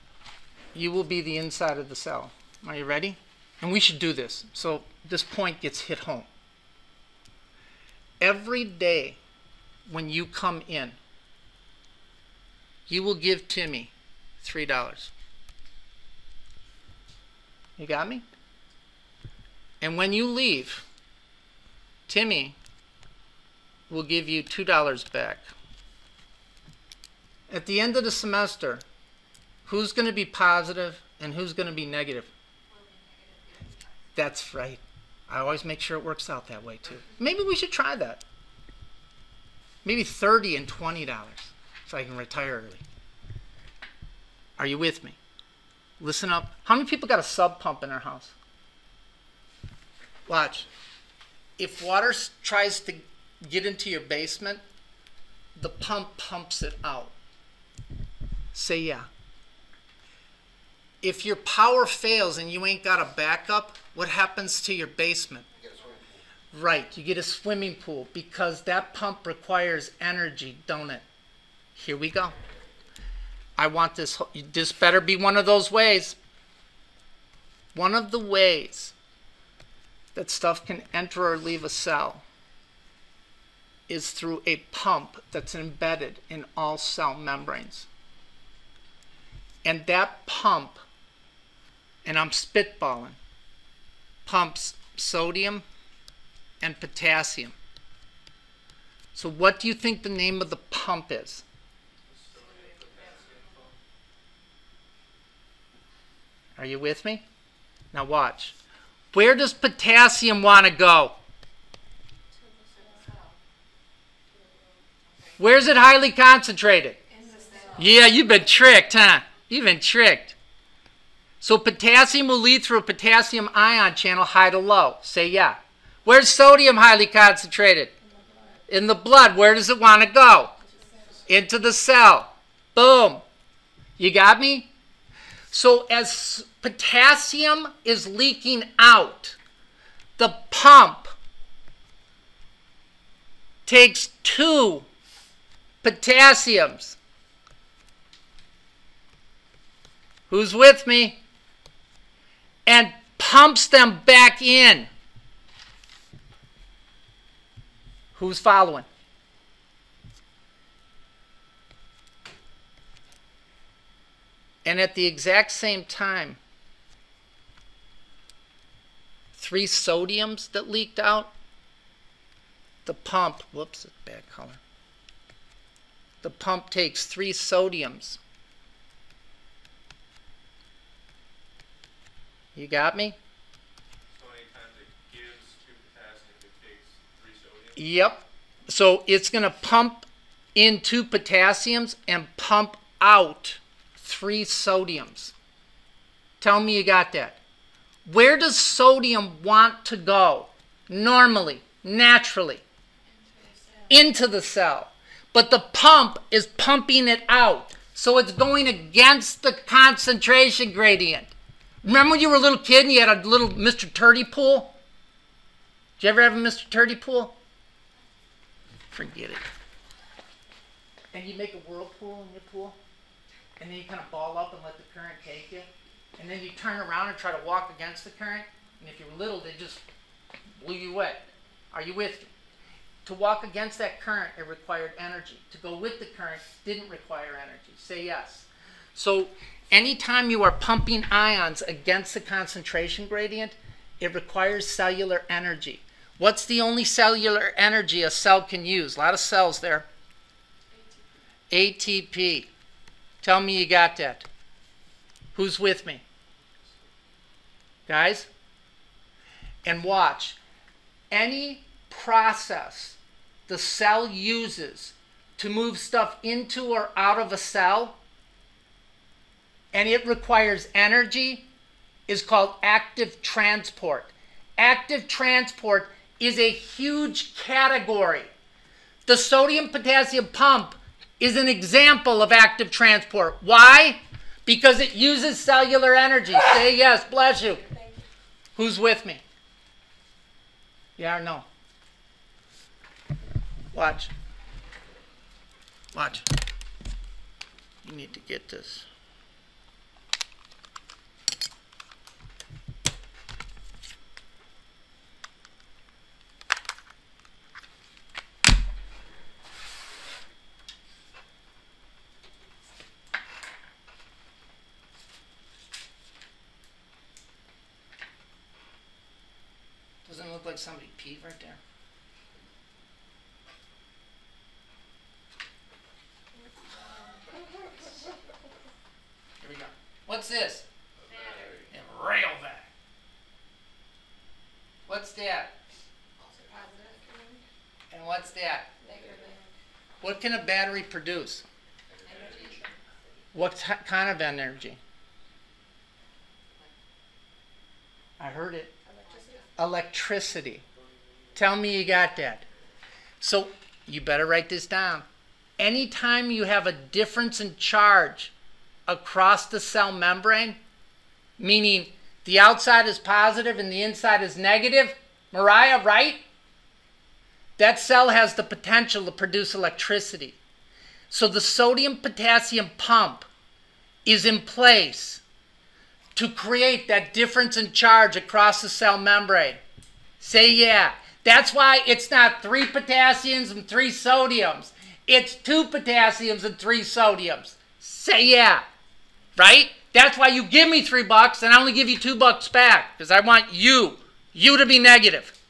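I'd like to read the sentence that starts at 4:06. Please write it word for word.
What's the only cellular energy a cell can use?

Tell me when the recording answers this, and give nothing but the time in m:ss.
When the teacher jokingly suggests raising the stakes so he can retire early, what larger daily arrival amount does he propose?
0:40.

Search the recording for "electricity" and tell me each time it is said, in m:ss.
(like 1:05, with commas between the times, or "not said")
5:49, 6:09.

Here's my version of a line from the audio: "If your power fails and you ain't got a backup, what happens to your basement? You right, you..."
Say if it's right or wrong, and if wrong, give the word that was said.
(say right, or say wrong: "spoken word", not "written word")
right.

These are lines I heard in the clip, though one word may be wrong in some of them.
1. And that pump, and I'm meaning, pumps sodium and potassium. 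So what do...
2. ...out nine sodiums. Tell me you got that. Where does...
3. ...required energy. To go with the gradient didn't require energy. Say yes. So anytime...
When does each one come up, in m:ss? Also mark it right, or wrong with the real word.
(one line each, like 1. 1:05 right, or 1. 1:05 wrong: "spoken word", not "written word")
1. 1:29 wrong: "spitballing", not "meaning"
2. 3:13 wrong: "three", not "nine"
3. 3:54 wrong: "current", not "gradient".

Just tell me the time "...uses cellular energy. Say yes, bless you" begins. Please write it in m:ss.
4:44.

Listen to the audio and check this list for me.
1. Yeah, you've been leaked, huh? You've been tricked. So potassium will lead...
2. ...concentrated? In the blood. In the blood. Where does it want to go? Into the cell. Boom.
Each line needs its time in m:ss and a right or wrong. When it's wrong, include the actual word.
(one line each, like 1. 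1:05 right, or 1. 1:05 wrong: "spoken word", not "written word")
1. 1:57 wrong: "tricked", not "leaked"
2. 2:07 right.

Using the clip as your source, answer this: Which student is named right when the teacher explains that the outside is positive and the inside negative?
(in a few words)
Mariah.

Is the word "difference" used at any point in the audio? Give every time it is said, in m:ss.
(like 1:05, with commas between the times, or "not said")
5:56, 6:17.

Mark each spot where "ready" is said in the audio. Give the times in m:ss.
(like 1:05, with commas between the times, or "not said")
0:02.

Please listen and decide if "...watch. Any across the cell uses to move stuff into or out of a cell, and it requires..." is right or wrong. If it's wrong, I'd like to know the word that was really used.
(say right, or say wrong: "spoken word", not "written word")
wrong: "process", not "across".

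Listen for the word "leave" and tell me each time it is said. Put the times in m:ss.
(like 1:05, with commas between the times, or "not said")
0:20, 1:21.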